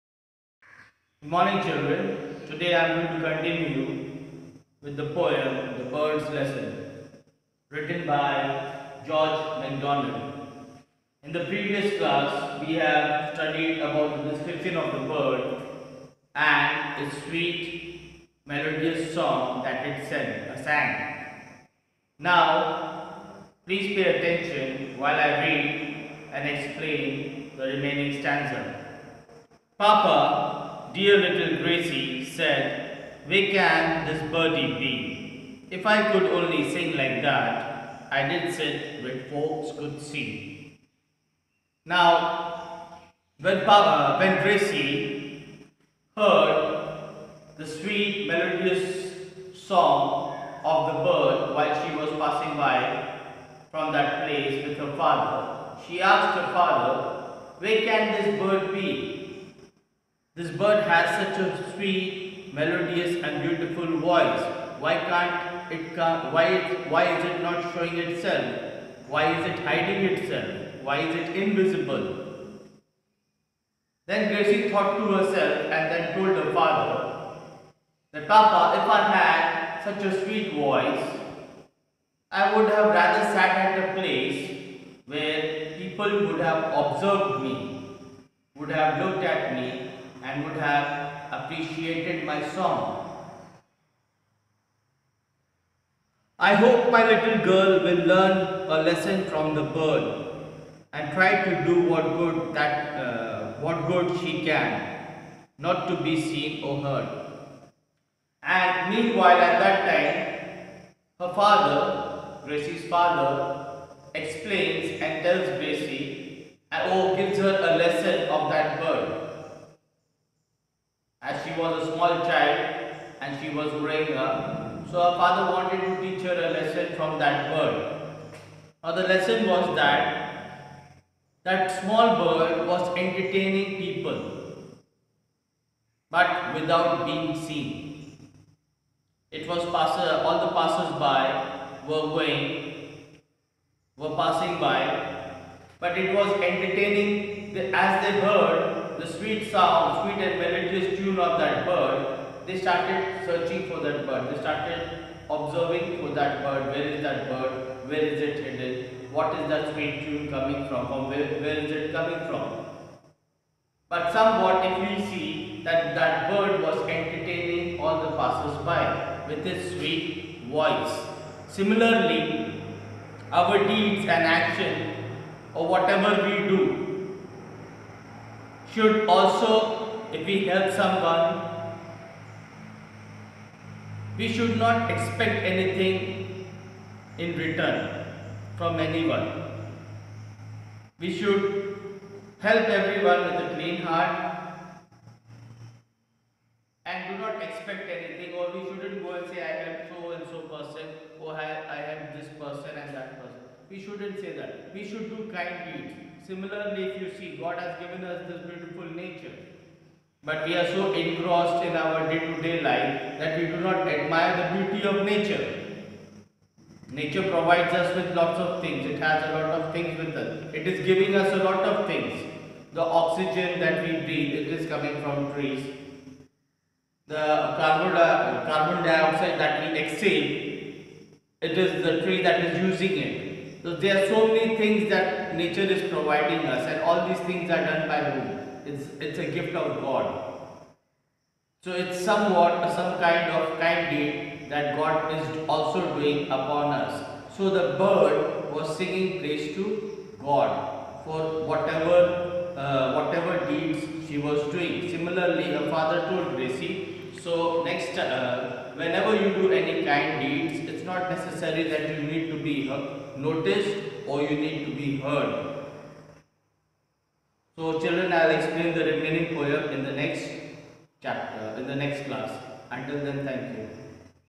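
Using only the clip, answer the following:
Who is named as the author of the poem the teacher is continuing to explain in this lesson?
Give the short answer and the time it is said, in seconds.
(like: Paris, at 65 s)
George MacDonald, at 9 s.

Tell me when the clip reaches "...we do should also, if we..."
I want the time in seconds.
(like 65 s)
176 s.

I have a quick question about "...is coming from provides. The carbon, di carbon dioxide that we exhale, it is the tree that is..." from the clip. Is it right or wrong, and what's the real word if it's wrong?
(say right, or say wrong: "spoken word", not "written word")
wrong: "trees", not "provides".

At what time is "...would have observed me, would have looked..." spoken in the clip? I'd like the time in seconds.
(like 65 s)
86 s.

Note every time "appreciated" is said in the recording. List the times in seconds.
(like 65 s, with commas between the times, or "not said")
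91 s.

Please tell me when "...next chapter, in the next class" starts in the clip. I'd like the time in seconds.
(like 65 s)
269 s.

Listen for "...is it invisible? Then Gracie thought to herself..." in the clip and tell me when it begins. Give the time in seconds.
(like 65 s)
71 s.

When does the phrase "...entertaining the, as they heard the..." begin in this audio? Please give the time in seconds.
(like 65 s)
146 s.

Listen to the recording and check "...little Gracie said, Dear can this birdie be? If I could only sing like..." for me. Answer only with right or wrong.
wrong.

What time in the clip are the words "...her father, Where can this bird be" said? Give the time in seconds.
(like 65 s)
56 s.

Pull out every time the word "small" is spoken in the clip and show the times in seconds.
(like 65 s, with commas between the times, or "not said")
121 s, 131 s.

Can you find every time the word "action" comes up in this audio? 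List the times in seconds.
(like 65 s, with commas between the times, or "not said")
174 s.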